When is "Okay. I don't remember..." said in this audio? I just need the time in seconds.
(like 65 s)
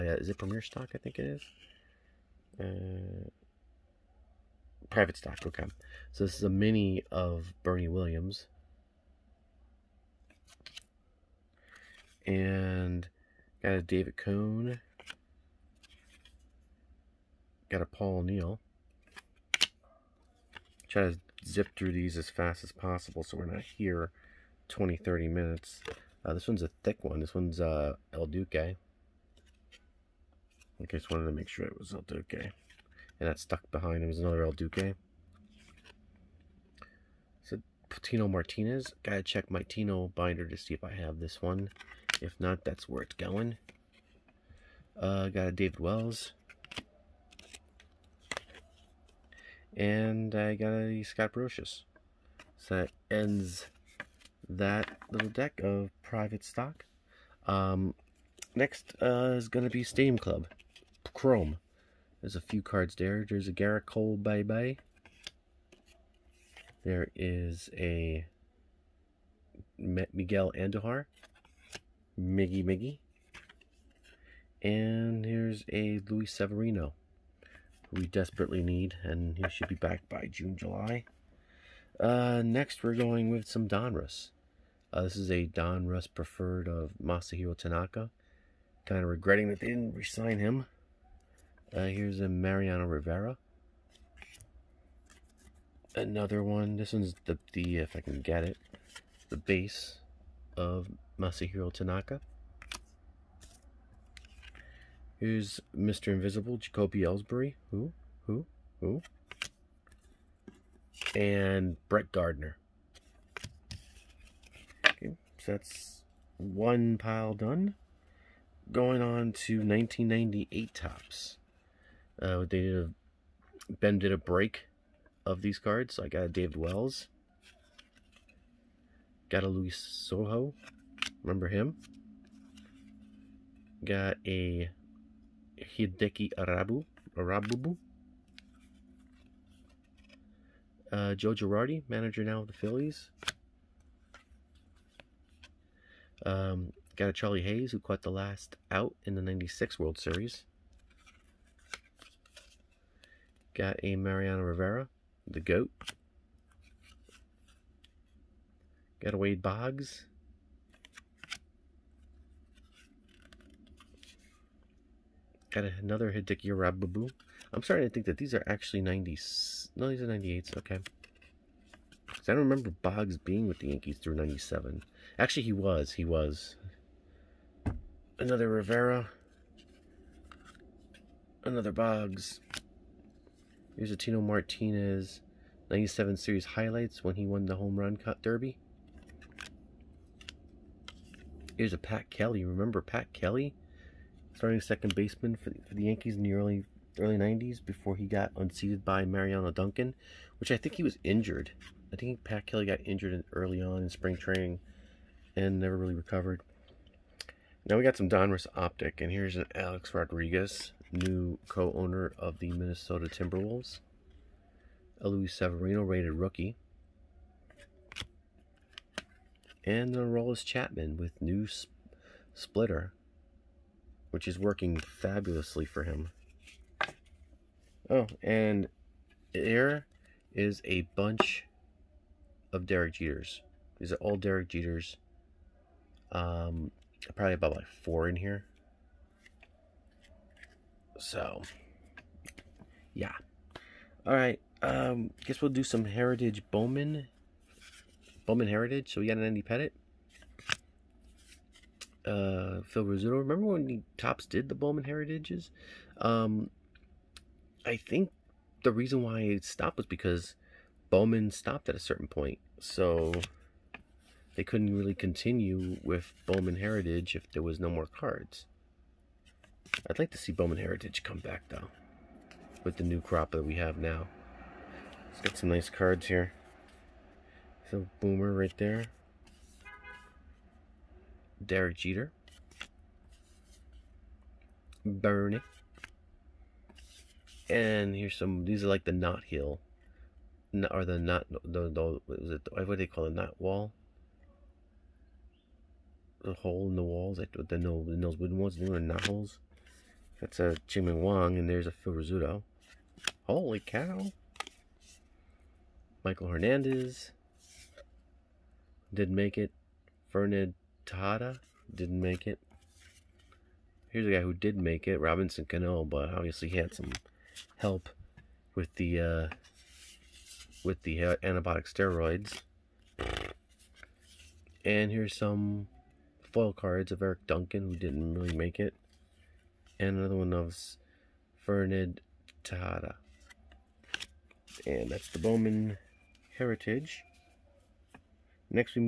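170 s.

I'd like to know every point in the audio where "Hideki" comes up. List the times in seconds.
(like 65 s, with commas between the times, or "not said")
135 s, 166 s.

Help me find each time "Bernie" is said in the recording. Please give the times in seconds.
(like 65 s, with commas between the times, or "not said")
7 s, 284 s.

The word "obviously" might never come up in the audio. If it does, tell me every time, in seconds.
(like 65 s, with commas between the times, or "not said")
316 s.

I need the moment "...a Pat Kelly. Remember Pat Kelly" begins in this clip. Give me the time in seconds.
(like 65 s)
191 s.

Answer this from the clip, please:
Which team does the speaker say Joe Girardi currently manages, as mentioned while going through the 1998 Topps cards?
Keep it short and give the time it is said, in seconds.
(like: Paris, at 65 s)
Phillies, at 142 s.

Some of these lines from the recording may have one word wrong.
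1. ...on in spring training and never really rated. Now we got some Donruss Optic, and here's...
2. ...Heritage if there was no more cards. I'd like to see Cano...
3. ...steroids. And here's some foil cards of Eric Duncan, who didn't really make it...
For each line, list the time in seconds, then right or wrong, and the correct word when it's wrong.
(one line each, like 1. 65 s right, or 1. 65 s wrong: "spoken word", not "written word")
1. 203 s wrong: "recovered", not "rated"
2. 266 s wrong: "Bowman", not "Cano"
3. 321 s right.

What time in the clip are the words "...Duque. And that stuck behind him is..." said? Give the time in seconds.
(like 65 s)
32 s.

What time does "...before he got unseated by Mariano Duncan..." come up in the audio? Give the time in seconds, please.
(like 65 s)
197 s.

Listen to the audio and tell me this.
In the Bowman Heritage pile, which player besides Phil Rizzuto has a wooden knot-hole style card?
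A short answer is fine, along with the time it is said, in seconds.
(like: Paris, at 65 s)
Chien-Ming Wang, at 300 s.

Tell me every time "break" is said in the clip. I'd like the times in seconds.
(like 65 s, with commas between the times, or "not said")
124 s.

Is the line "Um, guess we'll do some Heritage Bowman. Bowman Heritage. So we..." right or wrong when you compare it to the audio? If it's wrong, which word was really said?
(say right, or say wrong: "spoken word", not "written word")
right.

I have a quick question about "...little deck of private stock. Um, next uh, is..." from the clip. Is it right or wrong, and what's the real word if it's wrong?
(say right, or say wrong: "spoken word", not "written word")
right.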